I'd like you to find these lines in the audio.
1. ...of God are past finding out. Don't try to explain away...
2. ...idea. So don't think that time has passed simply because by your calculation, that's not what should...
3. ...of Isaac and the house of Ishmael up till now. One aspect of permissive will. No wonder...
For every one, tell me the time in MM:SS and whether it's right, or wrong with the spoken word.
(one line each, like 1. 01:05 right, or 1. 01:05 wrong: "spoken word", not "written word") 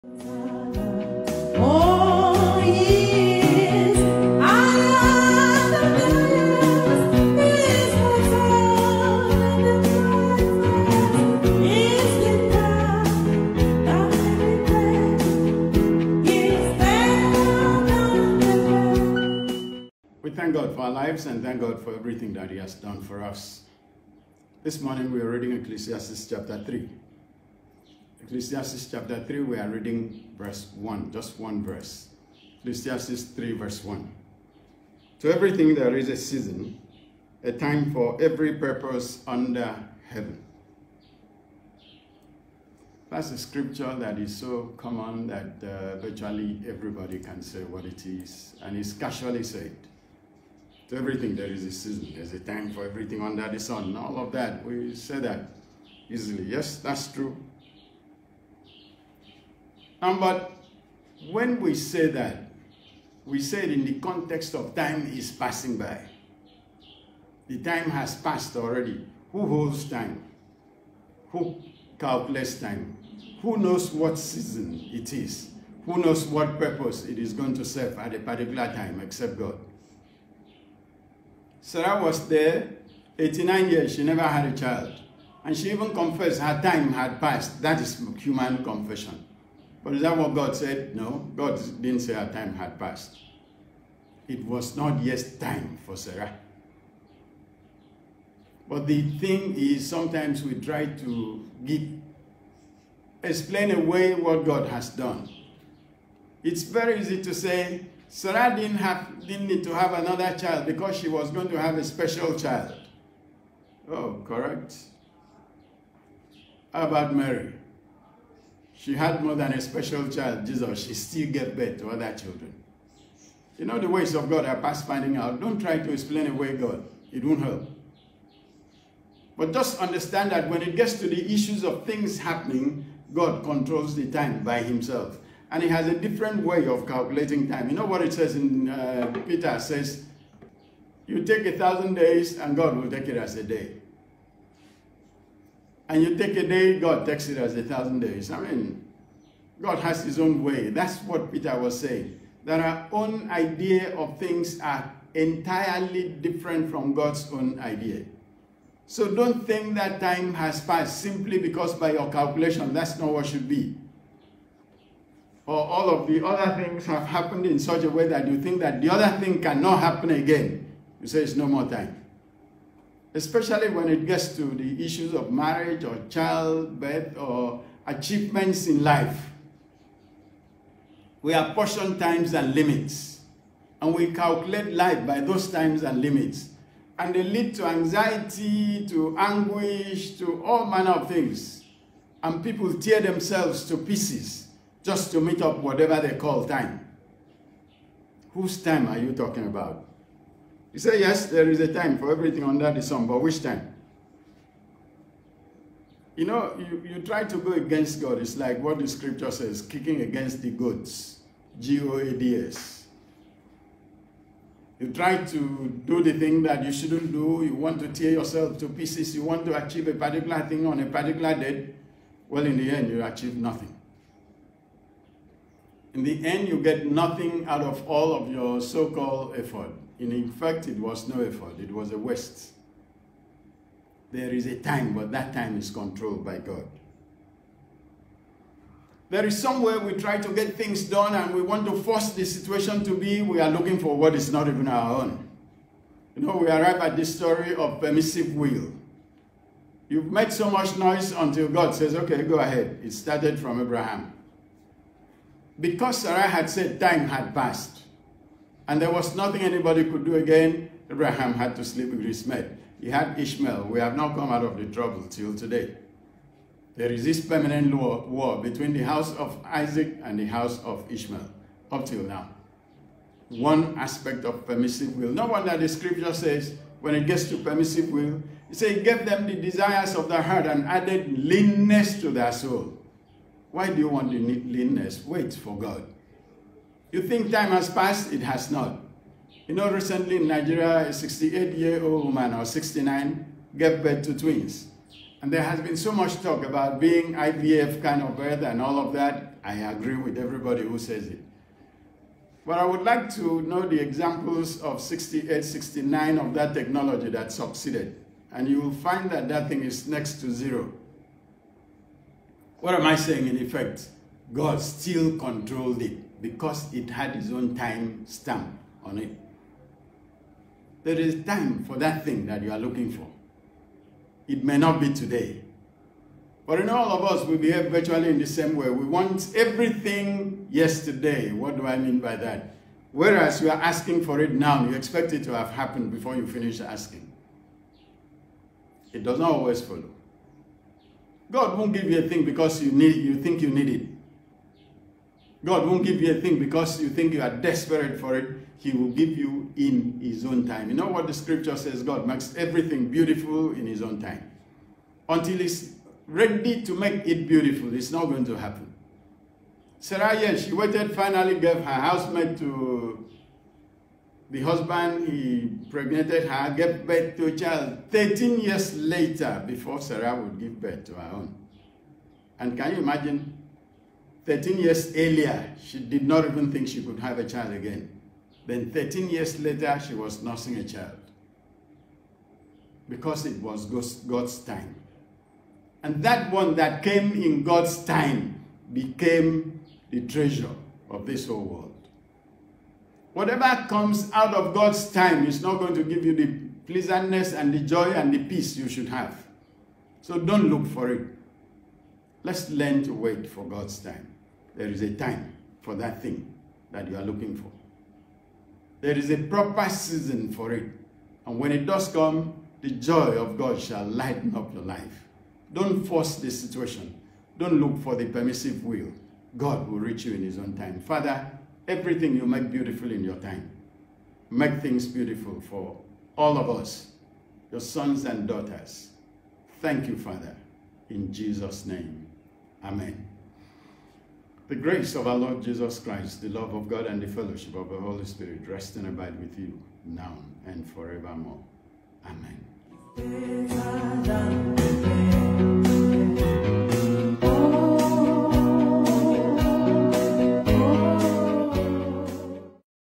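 1. 02:04 right
2. 02:37 right
3. 04:29 right.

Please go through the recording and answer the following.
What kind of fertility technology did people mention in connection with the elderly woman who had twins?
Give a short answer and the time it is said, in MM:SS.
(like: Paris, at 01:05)
IVF, at 04:57.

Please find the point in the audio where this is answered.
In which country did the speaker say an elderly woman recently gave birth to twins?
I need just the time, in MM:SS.
04:50.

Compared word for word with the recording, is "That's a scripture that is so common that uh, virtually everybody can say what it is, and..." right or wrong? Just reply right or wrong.
right.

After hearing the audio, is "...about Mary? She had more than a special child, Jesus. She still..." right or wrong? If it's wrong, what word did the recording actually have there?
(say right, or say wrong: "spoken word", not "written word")
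right.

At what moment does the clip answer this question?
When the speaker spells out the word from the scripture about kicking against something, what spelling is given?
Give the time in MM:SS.
03:31.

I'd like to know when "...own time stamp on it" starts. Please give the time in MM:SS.
05:17.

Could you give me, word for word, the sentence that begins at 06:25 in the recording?
And that one that came in God's time became the treasure of this whole world.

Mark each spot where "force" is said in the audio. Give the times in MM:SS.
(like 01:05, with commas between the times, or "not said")
04:01, 06:55.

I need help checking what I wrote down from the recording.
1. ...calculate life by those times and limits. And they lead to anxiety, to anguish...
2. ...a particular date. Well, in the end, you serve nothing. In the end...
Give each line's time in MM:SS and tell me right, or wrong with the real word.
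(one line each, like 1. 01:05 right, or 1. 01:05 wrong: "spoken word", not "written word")
1. 03:04 right
2. 03:40 wrong: "achieve", not "serve".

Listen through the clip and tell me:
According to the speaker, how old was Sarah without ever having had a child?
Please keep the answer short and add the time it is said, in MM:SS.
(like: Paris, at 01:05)
89, at 01:23.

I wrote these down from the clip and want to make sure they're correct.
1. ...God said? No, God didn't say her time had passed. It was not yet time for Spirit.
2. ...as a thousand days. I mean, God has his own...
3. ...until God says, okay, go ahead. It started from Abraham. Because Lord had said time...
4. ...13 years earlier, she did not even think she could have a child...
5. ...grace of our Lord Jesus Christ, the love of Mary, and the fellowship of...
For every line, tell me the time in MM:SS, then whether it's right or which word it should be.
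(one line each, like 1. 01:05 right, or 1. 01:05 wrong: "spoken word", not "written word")
1. 01:30 wrong: "Sarah", not "Spirit"
2. 02:27 right
3. 04:11 wrong: "Sarah", not "Lord"
4. 06:14 right
5. 07:14 wrong: "God", not "Mary".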